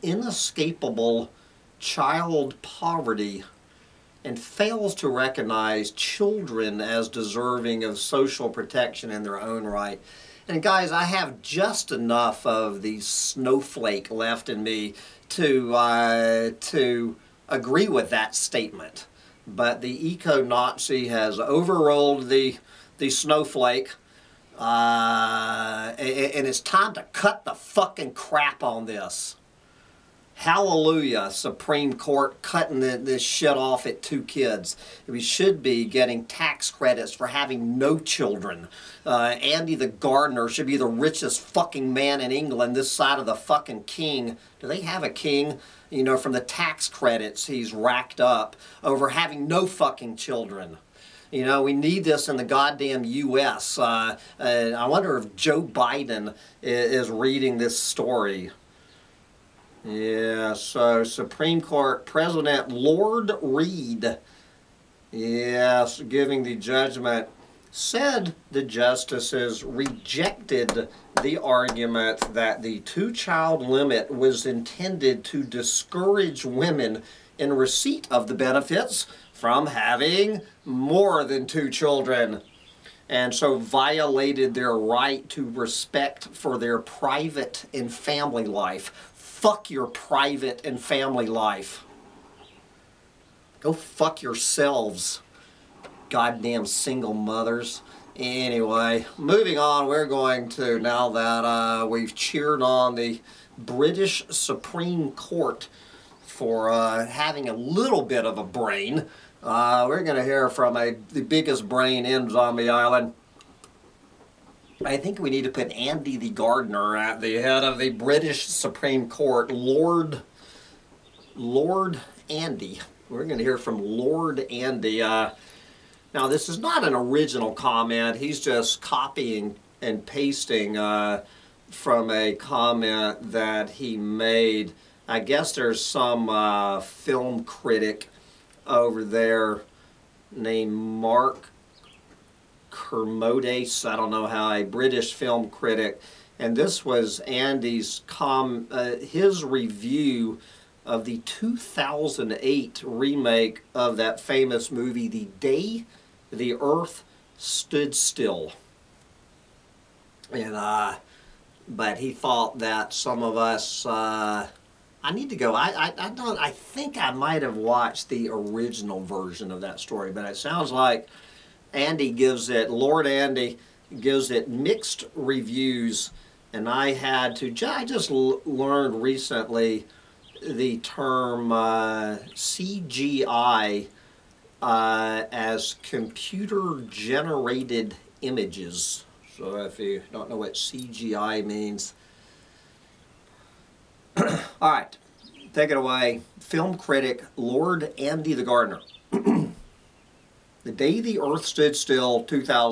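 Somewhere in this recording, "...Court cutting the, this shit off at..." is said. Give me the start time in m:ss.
0:31.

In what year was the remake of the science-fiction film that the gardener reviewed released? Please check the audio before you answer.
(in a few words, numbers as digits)
2008.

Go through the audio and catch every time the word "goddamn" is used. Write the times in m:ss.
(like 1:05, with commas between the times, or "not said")
0:52, 1:36.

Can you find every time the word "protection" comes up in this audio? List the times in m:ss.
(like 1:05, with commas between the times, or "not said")
0:08.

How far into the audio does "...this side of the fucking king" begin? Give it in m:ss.
0:42.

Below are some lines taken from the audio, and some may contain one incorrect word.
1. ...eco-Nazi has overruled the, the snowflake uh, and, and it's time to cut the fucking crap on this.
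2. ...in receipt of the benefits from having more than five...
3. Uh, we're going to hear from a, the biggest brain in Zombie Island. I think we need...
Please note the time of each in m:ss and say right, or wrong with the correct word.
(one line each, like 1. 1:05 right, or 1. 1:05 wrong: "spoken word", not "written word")
1. 0:20 right
2. 1:17 wrong: "two", not "five"
3. 1:49 right.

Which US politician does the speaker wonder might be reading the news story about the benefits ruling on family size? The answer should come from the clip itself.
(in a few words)
Joe Biden.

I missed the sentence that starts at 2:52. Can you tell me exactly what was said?
Lord Andy gives it mixed reviews, and I had to.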